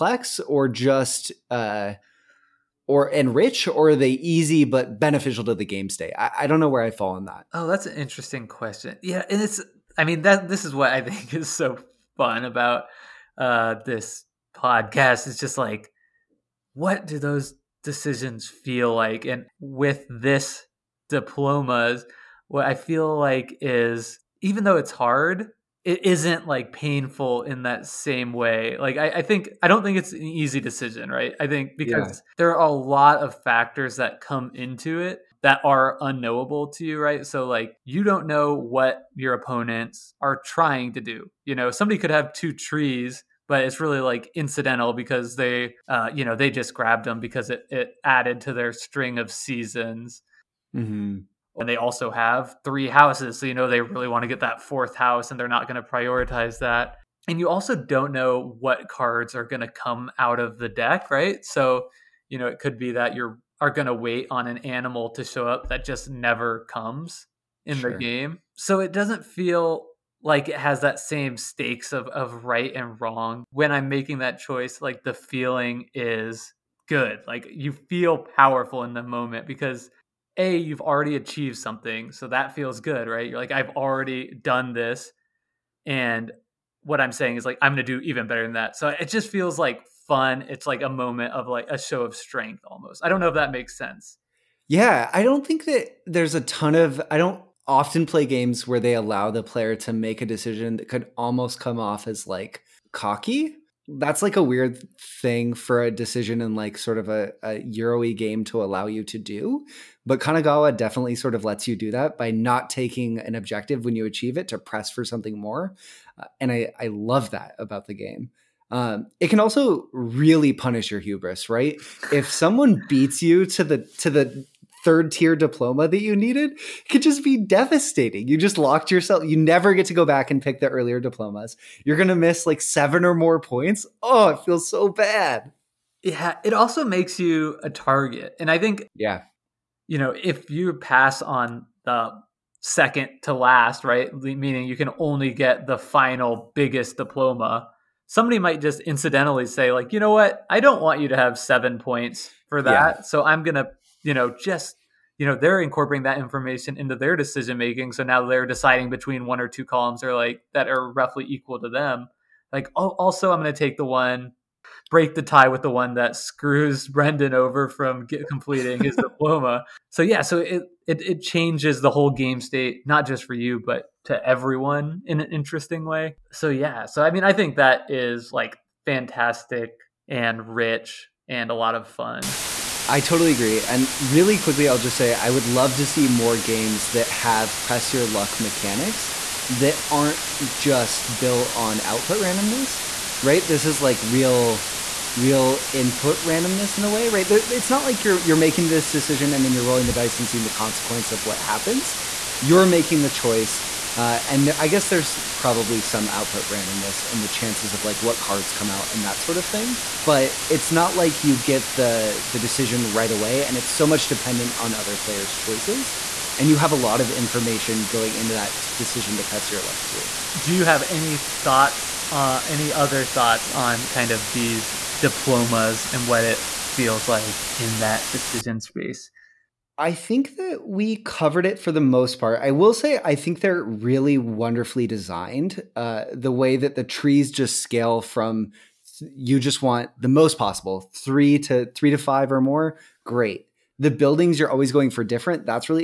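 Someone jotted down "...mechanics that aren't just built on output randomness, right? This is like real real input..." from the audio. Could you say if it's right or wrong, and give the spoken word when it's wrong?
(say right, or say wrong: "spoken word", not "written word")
right.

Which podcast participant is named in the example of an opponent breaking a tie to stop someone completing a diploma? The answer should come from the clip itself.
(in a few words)
Brendan.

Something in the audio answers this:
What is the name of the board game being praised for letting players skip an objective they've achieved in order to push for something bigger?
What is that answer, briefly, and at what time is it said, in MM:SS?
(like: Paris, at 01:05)
Kanagawa, at 01:50.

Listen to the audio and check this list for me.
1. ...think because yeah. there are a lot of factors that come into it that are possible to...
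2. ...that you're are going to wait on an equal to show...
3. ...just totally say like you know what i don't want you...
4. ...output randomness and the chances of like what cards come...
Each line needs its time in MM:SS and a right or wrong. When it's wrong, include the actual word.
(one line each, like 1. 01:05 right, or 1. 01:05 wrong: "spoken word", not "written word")
1. 00:31 wrong: "unknowable", not "possible"
2. 01:02 wrong: "animal", not "equal"
3. 02:28 wrong: "incidentally", not "totally"
4. 03:26 right.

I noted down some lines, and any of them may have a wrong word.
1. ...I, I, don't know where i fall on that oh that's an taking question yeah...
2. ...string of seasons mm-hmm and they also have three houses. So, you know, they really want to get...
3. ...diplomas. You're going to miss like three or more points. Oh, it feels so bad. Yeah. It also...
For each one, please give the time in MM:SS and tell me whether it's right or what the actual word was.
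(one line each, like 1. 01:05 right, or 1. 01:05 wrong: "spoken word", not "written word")
1. 00:06 wrong: "interesting", not "taking"
2. 00:48 right
3. 02:10 wrong: "seven", not "three".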